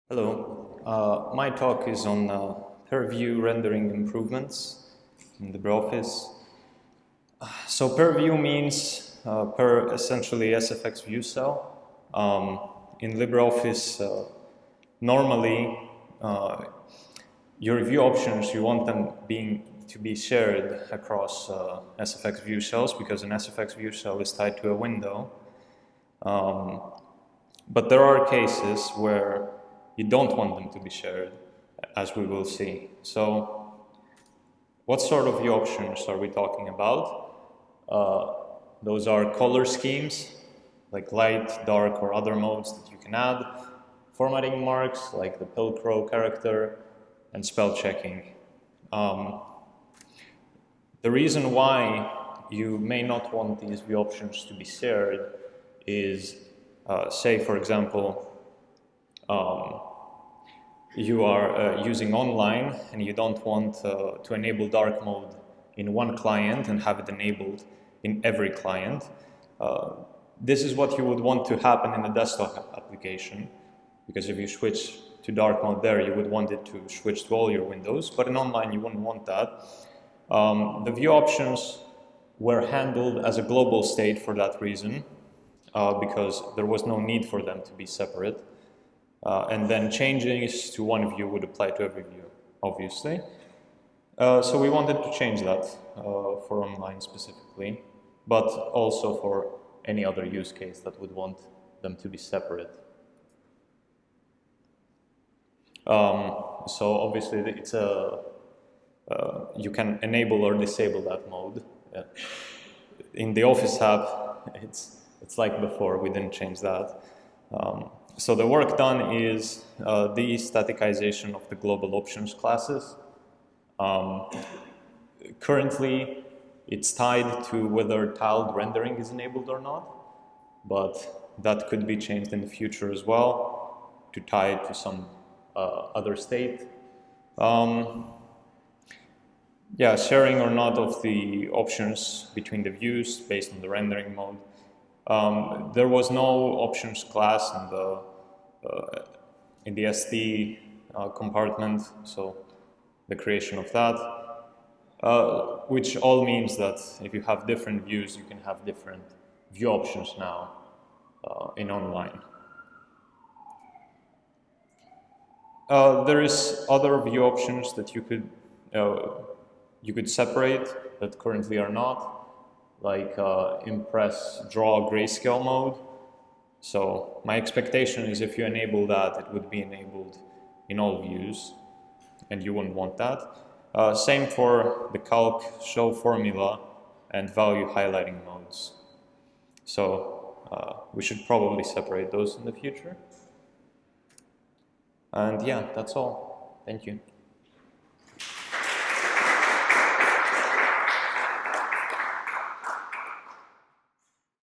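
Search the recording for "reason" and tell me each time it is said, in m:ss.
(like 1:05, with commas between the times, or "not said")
0:51, 1:24.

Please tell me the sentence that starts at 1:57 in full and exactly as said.
Um, so the work done is uh, the staticization of the global options classes.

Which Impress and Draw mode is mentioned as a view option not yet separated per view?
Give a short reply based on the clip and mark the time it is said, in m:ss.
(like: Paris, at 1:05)
grayscale mode, at 2:54.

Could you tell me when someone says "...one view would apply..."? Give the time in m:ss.
1:30.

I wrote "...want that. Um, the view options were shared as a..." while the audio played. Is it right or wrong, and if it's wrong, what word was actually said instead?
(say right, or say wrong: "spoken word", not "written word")
wrong: "handled", not "shared".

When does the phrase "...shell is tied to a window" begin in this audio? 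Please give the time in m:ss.
0:23.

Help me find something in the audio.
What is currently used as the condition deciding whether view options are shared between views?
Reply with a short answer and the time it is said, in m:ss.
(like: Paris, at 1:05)
tiled rendering, at 2:08.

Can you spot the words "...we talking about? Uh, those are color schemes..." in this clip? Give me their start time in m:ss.
0:36.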